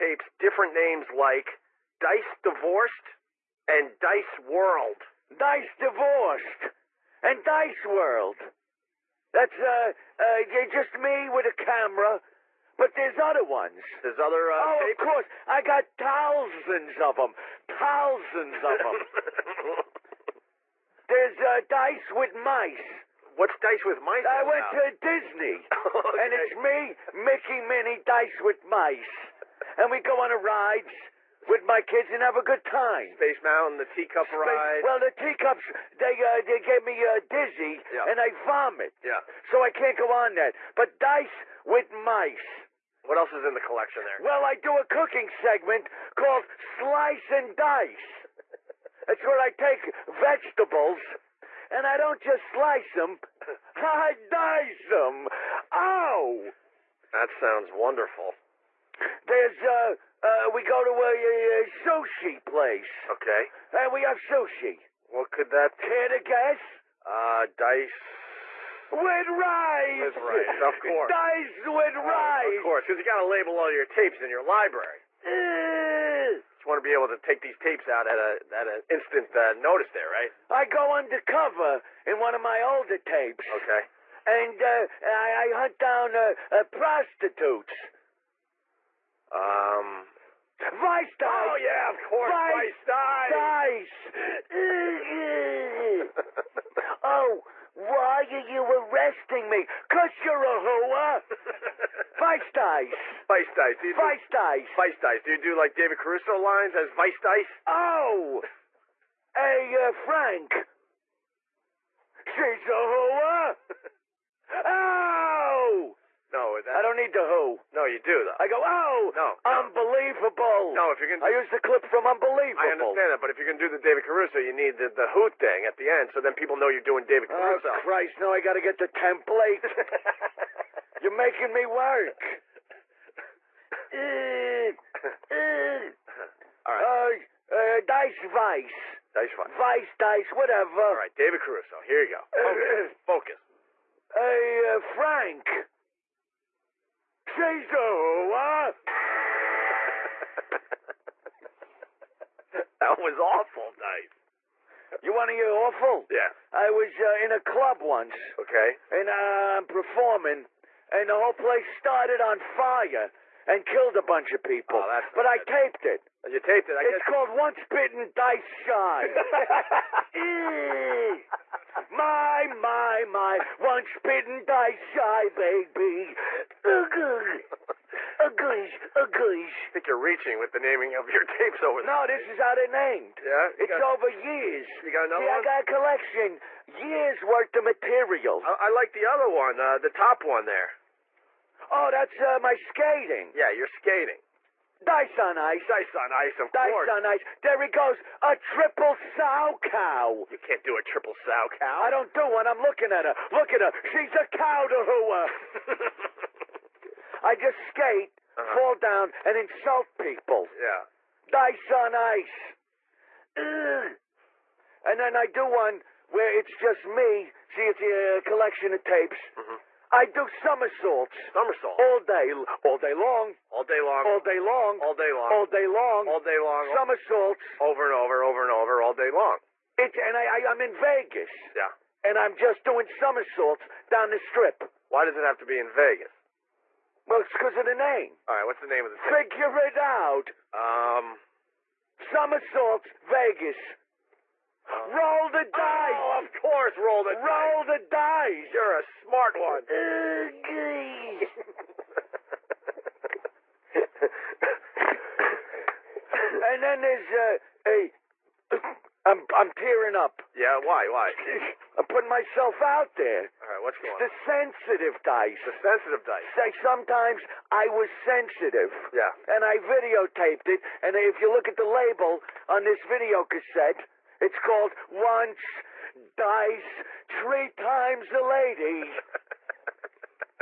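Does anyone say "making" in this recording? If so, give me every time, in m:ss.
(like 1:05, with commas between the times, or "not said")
2:11.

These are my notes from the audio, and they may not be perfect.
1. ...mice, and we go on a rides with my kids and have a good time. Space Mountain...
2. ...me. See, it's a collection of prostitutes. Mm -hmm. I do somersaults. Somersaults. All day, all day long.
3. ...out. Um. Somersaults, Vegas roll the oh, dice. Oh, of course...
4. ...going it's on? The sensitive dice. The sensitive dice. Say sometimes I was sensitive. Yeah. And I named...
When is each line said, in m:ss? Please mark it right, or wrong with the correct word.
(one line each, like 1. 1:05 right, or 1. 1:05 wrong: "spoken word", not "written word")
1. 0:28 right
2. 3:36 wrong: "tapes", not "prostitutes"
3. 3:59 right
4. 4:23 wrong: "videotaped", not "named".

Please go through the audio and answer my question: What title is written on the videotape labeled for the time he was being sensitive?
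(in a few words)
Once, Dice, Three Times a Lady.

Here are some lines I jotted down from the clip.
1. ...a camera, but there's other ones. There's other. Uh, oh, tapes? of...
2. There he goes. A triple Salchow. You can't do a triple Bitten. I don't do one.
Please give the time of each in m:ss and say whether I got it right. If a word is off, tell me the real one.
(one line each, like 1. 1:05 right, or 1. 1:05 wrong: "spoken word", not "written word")
1. 0:11 right
2. 3:17 wrong: "Salchow", not "Bitten".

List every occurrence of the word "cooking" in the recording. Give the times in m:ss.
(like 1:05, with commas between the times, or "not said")
0:44.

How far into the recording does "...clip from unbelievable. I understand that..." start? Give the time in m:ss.
2:01.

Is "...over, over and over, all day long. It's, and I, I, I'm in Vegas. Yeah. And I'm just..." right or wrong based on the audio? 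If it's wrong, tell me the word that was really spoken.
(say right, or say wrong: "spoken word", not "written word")
right.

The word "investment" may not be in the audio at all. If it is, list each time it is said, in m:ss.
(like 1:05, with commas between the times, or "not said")
not said.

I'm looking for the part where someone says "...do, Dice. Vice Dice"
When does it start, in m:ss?
1:44.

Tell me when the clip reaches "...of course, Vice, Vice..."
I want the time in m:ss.
1:31.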